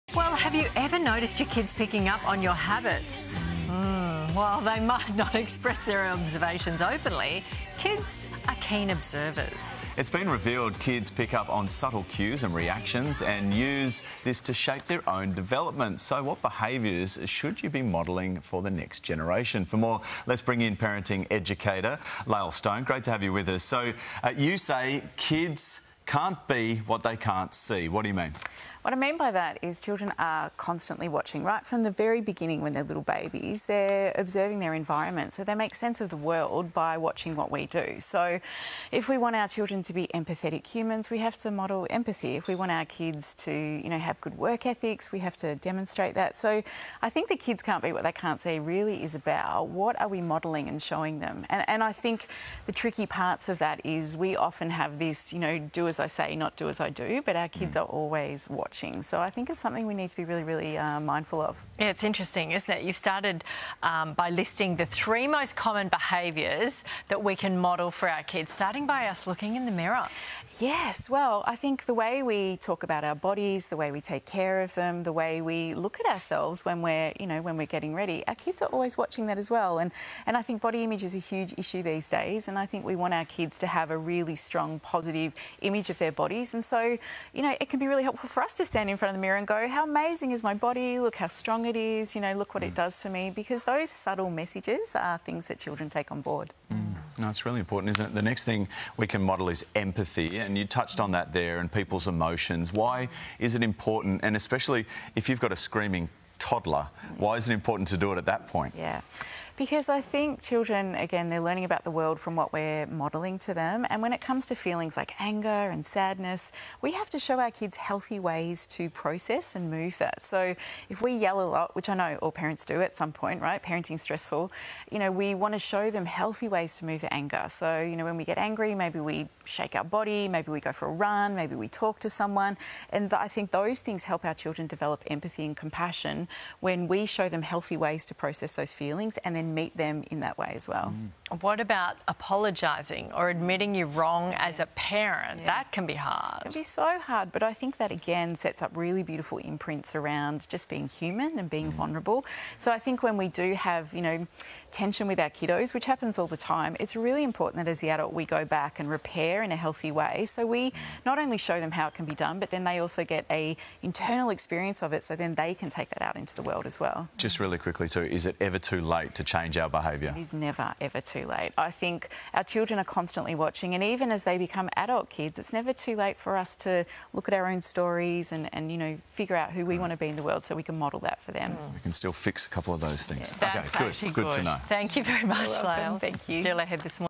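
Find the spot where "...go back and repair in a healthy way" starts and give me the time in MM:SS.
02:38.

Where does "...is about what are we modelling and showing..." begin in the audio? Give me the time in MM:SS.
00:49.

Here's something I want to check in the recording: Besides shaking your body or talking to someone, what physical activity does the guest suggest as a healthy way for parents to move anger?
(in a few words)
Go for a run.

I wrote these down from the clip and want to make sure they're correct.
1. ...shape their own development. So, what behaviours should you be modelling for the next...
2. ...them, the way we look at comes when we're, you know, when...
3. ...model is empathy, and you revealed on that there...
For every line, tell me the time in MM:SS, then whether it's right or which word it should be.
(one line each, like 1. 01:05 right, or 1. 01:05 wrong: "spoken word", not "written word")
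1. 00:14 right
2. 01:14 wrong: "ourselves", not "comes"
3. 01:39 wrong: "touched", not "revealed".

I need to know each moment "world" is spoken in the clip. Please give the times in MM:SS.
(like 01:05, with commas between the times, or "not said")
00:36, 01:51, 02:46, 03:00.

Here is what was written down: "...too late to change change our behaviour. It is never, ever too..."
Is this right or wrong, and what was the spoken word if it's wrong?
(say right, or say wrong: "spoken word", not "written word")
right.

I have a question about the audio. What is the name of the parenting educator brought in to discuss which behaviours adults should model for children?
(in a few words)
Lael Stone.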